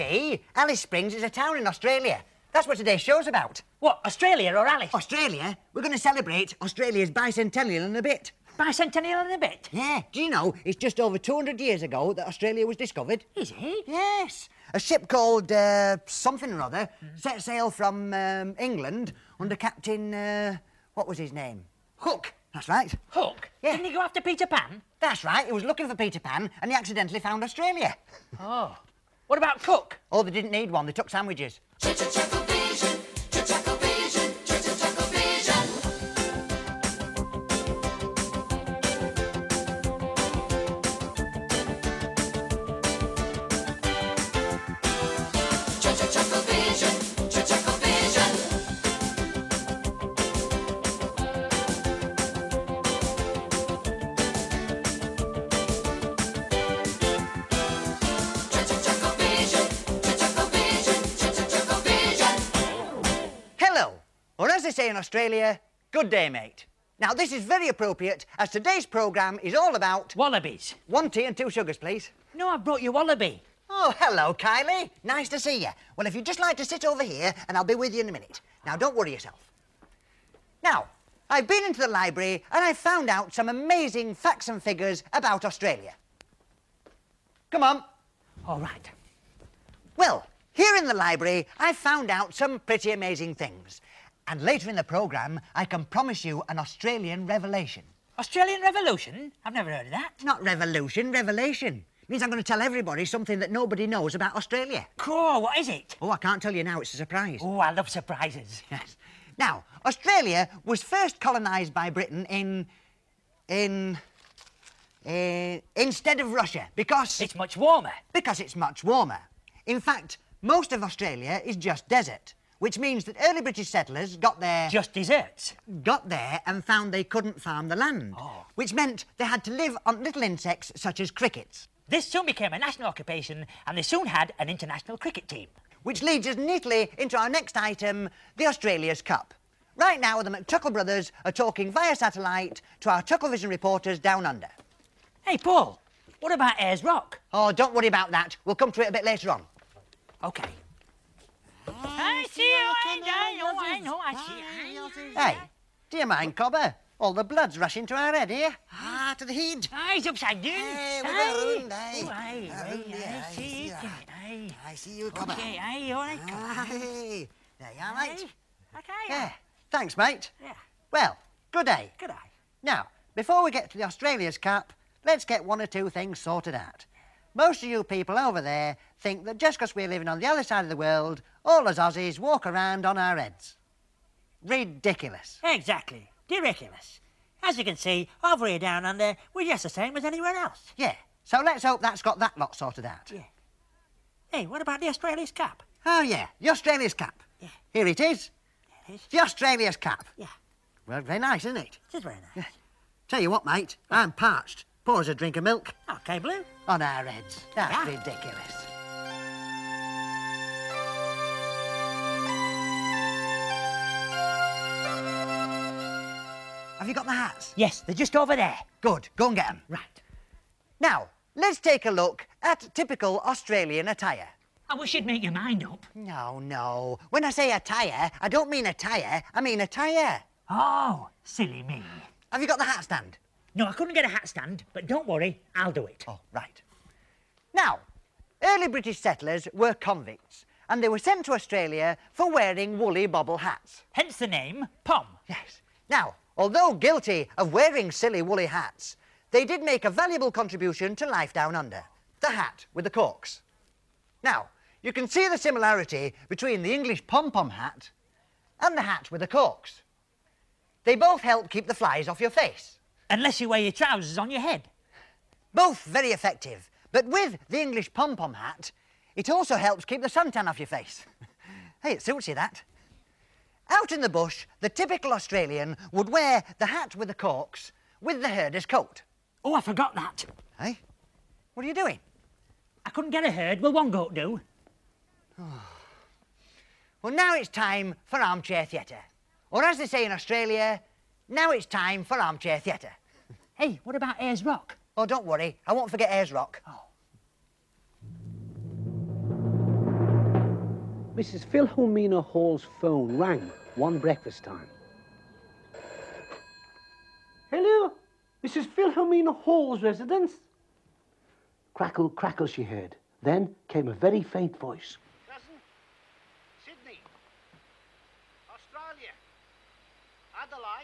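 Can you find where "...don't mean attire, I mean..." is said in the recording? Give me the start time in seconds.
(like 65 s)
228 s.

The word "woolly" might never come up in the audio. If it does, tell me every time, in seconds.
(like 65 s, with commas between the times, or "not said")
242 s, 248 s.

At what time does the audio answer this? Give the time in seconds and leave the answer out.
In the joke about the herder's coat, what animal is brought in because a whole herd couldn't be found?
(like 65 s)
283 s.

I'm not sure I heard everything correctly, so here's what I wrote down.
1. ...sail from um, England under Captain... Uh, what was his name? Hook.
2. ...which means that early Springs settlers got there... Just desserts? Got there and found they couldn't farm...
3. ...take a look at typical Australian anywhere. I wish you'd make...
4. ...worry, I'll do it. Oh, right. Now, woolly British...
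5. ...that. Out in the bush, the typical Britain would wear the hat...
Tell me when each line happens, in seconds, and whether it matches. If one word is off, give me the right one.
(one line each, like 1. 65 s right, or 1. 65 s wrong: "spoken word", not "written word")
1. 17 s right
2. 122 s wrong: "British", not "Springs"
3. 221 s wrong: "attire", not "anywhere"
4. 235 s wrong: "early", not "woolly"
5. 272 s wrong: "Australian", not "Britain".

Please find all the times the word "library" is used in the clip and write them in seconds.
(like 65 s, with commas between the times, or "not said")
81 s, 90 s.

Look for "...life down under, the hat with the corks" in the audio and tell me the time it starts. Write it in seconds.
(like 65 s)
251 s.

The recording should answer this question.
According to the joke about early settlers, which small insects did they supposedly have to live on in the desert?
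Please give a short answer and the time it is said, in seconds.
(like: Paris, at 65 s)
crickets, at 131 s.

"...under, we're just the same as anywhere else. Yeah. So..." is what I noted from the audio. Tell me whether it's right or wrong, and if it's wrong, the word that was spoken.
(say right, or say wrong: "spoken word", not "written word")
right.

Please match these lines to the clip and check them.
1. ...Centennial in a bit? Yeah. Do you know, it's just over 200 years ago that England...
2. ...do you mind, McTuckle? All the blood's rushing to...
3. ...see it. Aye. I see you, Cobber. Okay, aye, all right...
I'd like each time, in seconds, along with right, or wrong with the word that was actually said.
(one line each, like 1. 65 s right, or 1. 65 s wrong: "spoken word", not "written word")
1. 8 s wrong: "Australia", not "England"
2. 155 s wrong: "Cobber", not "McTuckle"
3. 163 s right.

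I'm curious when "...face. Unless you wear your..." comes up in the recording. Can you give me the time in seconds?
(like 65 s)
262 s.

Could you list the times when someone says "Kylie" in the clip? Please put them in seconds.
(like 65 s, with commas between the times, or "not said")
74 s.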